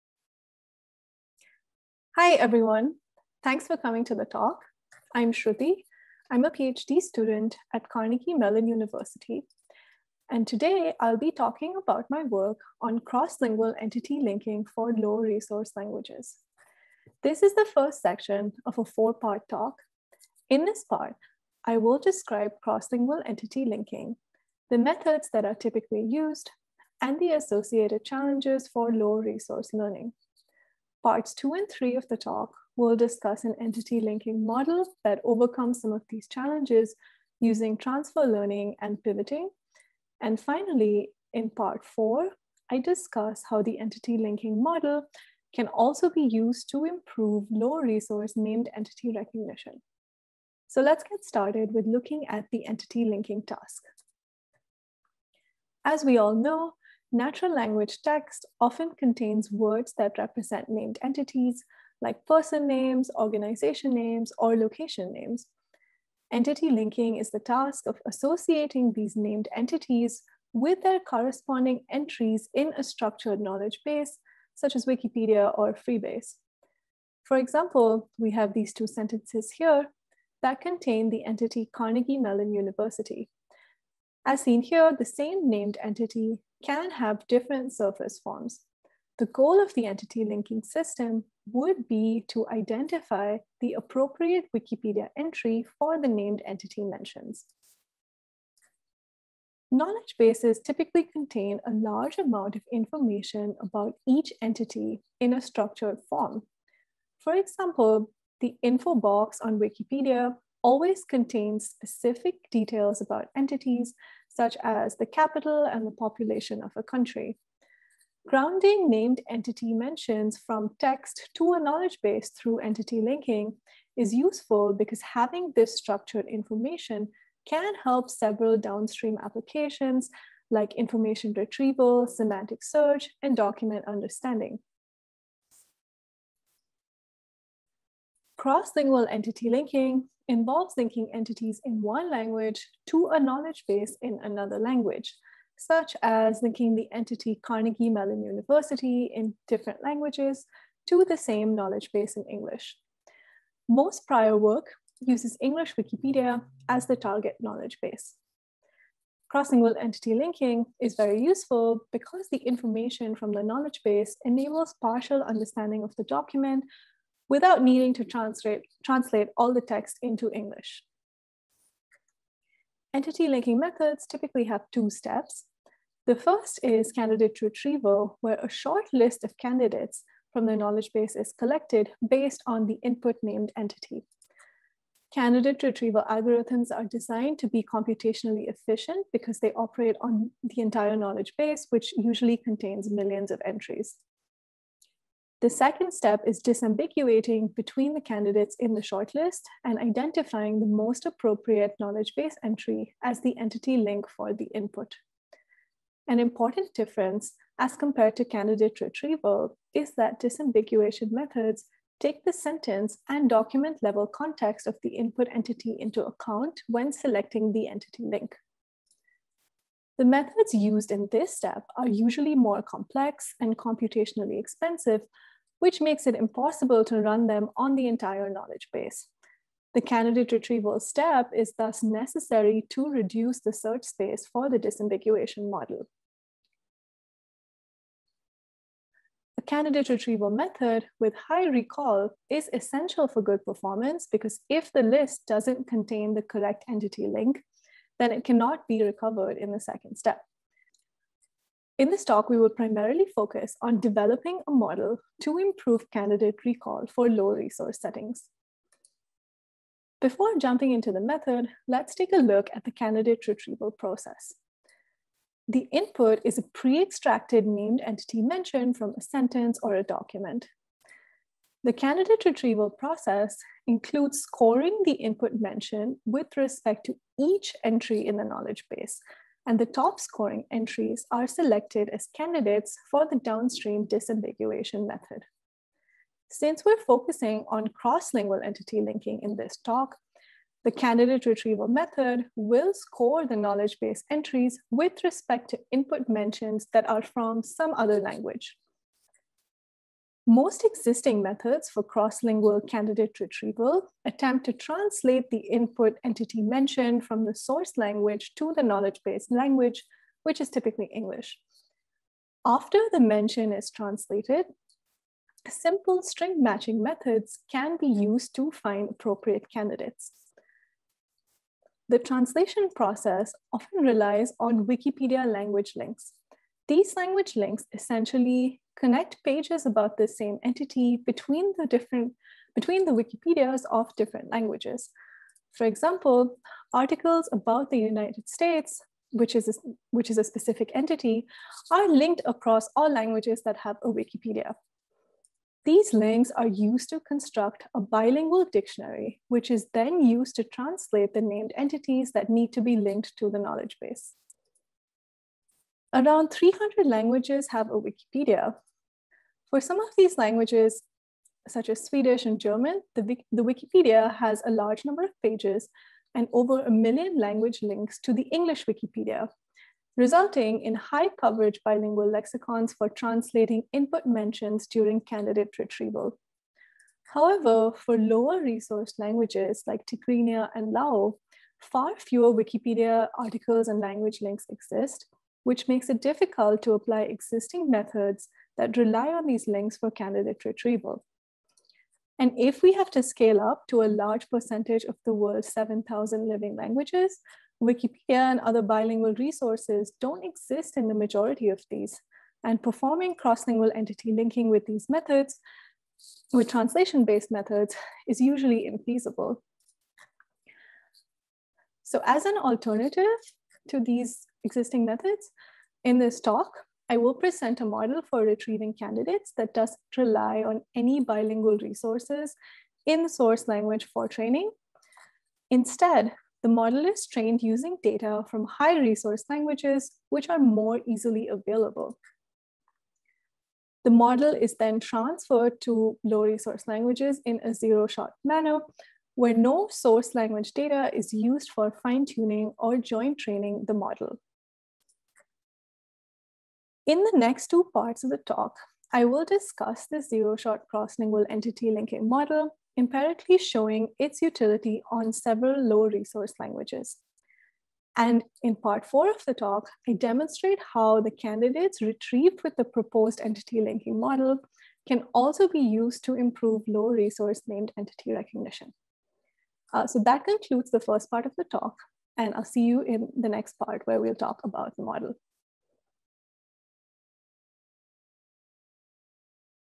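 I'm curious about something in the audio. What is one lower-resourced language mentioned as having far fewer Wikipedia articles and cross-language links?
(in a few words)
Tigrinya.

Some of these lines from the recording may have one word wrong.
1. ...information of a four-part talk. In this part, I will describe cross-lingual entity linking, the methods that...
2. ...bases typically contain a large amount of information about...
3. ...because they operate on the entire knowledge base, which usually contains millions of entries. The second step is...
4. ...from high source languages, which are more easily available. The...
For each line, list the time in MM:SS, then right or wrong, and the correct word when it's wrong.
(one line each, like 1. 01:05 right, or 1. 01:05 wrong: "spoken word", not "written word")
1. 00:18 wrong: "section", not "information"
2. 01:40 right
3. 03:09 right
4. 07:08 wrong: "resource", not "source".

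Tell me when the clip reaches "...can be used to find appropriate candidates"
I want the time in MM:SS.
05:17.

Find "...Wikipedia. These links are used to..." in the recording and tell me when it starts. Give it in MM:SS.
05:43.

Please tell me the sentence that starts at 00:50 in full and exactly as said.
So let's get started with looking at the entity linking task.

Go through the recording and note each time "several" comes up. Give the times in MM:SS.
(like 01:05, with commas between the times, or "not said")
02:08, 07:35.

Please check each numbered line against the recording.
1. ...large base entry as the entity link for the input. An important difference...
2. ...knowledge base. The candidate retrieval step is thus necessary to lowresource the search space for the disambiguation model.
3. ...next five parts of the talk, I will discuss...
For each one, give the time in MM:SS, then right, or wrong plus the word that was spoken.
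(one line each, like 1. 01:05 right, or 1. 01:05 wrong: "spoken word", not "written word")
1. 03:21 wrong: "knowledge", not "large"
2. 03:48 wrong: "reduce", not "lowresource"
3. 07:27 wrong: "two", not "five".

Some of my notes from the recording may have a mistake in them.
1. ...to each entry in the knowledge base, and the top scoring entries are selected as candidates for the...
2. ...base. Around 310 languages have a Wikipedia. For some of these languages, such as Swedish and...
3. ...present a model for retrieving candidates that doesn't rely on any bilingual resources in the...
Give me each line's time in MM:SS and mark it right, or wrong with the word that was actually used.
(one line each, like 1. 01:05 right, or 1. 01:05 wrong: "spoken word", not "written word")
1. 04:36 right
2. 05:53 wrong: "300", not "310"
3. 06:57 right.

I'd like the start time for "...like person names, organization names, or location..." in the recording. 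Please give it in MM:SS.
01:02.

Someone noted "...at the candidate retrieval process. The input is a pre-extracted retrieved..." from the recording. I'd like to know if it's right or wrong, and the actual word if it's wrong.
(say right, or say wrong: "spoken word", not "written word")
wrong: "named", not "retrieved".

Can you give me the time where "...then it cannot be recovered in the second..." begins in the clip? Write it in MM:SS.
04:08.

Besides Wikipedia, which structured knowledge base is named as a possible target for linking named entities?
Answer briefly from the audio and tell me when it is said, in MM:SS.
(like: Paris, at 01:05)
Freebase, at 01:15.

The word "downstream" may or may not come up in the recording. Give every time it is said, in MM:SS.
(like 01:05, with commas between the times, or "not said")
02:08, 04:43.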